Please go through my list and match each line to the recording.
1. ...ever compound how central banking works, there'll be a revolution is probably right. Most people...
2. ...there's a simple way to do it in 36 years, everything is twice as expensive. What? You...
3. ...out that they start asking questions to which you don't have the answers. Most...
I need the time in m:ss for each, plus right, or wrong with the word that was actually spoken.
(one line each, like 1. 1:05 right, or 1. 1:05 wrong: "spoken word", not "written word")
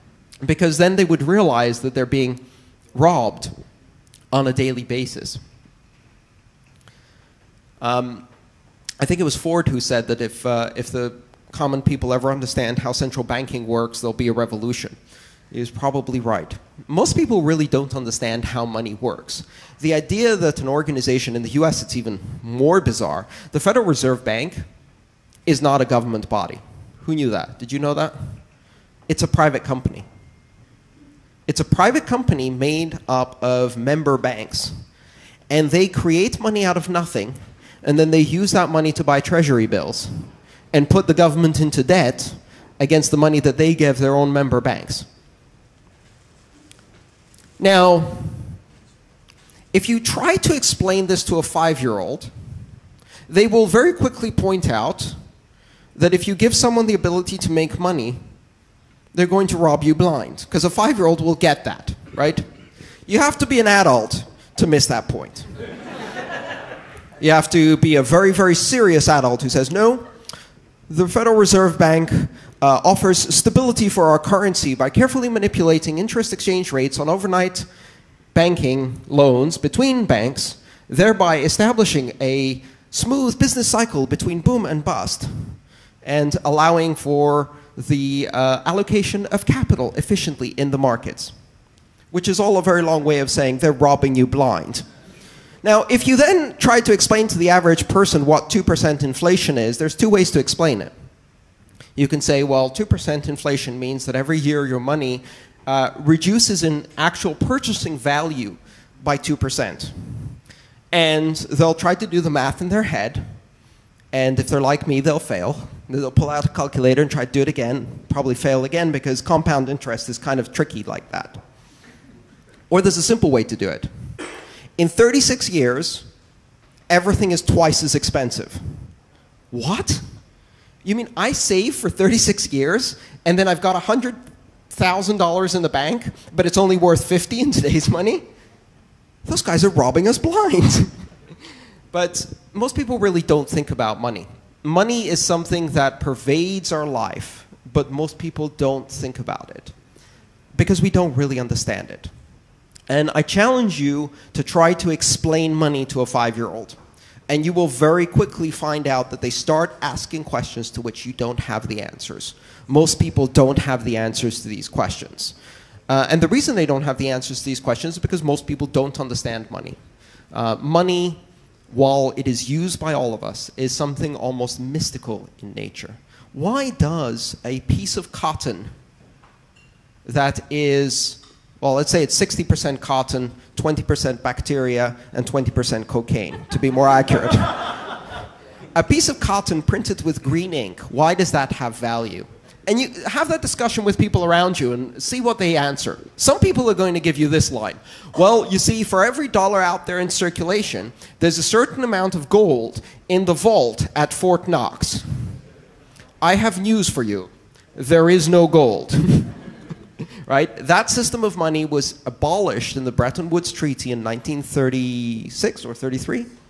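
1. 0:12 wrong: "understand", not "compound"
2. 2:02 right
3. 2:38 right.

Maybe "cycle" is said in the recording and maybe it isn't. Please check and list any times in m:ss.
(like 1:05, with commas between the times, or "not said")
1:23.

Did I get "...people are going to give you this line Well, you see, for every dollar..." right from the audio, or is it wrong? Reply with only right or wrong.
right.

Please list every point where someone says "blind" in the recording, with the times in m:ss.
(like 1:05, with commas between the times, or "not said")
0:59, 1:34, 2:20.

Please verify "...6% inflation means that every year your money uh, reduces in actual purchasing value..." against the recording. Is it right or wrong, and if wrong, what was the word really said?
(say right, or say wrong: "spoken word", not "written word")
wrong: "2", not "6".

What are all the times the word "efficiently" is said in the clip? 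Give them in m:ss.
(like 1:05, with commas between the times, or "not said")
1:29.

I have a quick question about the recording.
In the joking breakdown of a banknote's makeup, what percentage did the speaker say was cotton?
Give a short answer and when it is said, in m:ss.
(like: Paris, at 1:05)
60%, at 3:02.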